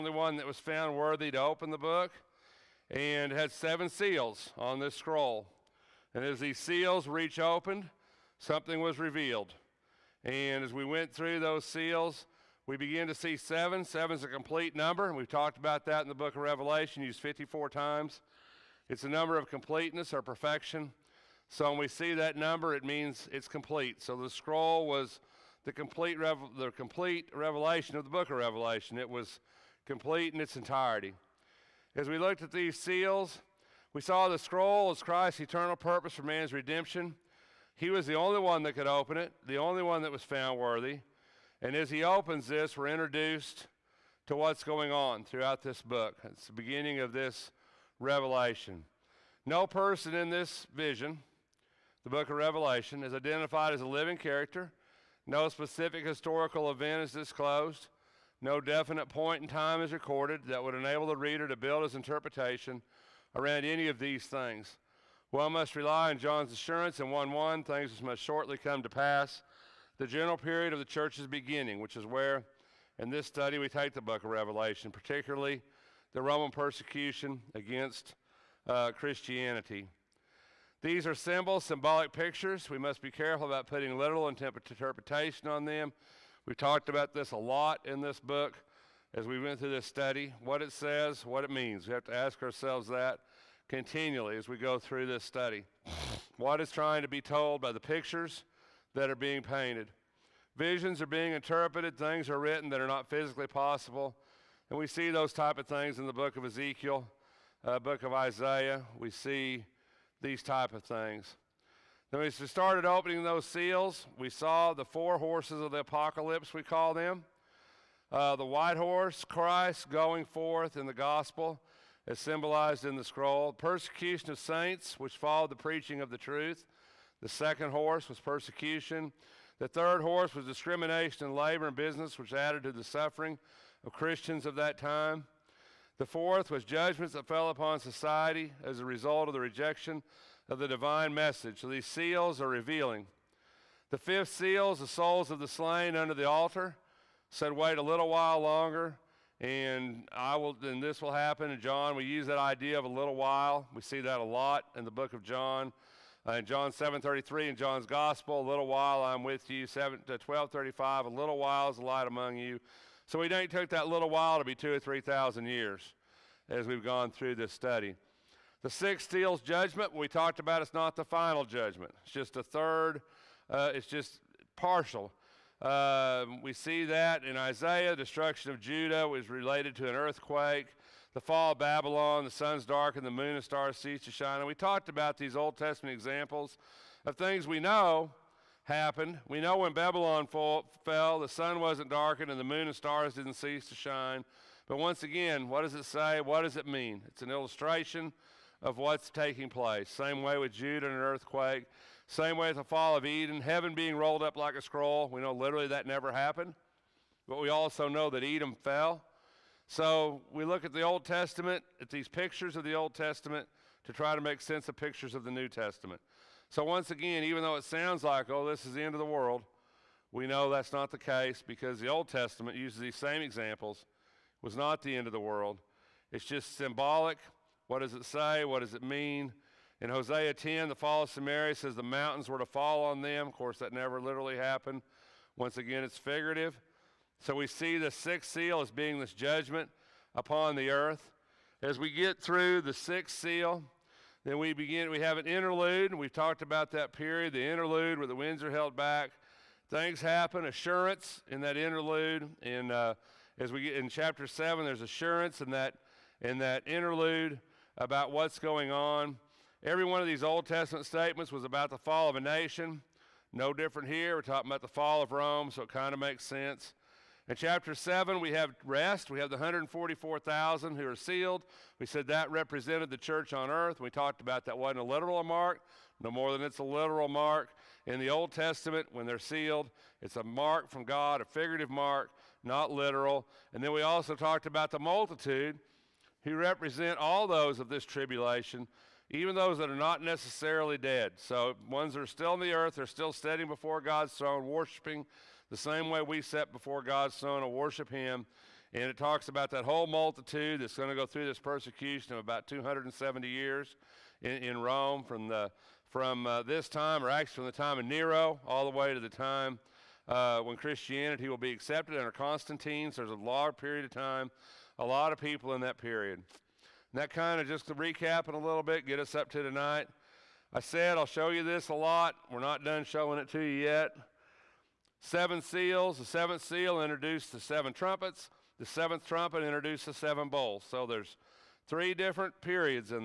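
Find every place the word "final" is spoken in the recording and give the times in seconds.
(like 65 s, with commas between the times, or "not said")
171 s.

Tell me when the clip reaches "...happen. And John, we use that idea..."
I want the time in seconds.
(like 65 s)
151 s.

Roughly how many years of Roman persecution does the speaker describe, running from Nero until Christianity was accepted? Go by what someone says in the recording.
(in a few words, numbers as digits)
270.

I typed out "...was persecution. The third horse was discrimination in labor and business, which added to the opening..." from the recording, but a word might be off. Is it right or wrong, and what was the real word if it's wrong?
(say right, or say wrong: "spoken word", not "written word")
wrong: "suffering", not "opening".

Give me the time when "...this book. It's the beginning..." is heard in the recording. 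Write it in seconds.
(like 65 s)
45 s.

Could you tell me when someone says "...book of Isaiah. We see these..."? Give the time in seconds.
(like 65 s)
107 s.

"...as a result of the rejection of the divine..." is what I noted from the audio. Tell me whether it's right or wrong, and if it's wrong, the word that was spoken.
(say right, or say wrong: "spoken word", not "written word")
right.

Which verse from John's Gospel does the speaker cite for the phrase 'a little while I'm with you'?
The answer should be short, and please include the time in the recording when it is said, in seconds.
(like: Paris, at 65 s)
John 7:33, at 156 s.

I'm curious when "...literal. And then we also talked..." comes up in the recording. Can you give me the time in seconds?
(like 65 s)
282 s.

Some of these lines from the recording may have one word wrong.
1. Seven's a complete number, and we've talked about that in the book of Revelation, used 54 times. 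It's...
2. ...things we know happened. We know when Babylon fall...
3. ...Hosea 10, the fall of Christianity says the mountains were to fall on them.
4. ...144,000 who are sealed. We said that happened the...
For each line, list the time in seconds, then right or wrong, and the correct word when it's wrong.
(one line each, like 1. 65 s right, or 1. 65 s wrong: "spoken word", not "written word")
1. 13 s right
2. 187 s right
3. 229 s wrong: "Samaria", not "Christianity"
4. 269 s wrong: "represented", not "happened".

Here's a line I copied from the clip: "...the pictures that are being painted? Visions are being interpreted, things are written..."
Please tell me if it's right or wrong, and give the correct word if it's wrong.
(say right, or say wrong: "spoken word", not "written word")
right.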